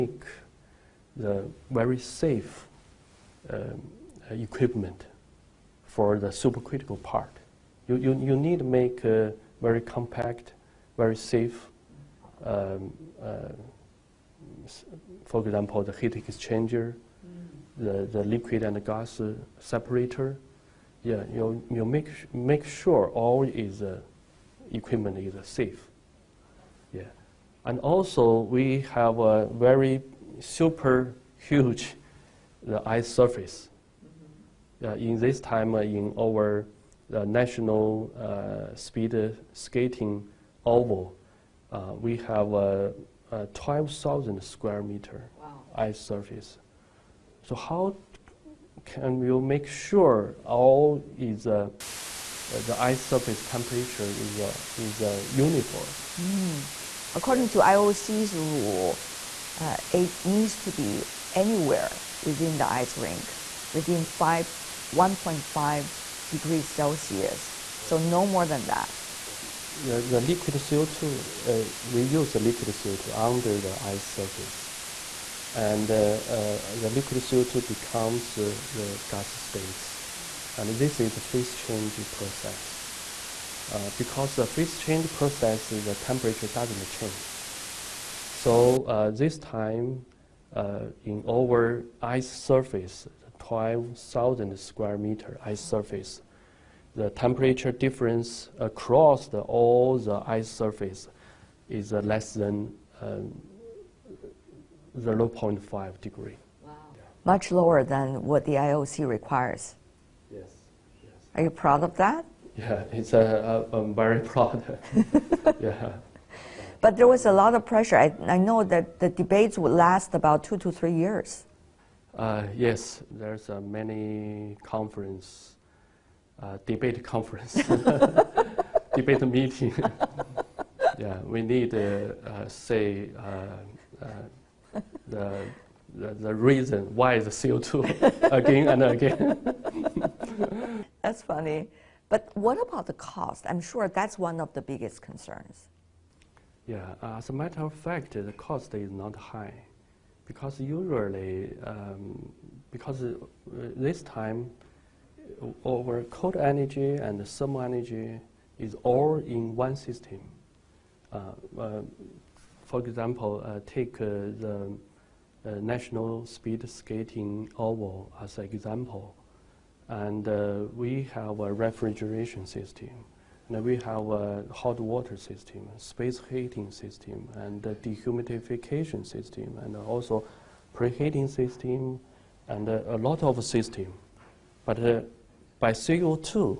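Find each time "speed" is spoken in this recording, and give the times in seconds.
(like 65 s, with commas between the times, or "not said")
38 s, 166 s.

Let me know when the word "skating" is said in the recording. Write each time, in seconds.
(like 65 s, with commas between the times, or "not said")
39 s, 166 s.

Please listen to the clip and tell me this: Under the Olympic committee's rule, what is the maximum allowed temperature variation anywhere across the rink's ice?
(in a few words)
1.5 degrees Celsius.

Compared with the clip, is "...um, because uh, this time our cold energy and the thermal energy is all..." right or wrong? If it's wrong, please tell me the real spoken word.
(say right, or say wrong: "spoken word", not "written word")
right.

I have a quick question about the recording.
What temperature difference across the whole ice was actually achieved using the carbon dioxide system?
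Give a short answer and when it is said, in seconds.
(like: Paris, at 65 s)
less than 0.5 degree, at 102 s.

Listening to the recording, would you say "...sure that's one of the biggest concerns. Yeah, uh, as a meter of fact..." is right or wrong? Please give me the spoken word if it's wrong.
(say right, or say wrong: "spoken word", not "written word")
wrong: "matter", not "meter".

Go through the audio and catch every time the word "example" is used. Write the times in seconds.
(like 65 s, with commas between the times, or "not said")
15 s, 162 s, 168 s.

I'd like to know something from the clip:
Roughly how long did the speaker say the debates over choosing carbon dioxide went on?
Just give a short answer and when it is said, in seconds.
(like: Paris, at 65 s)
2 to 3 years, at 120 s.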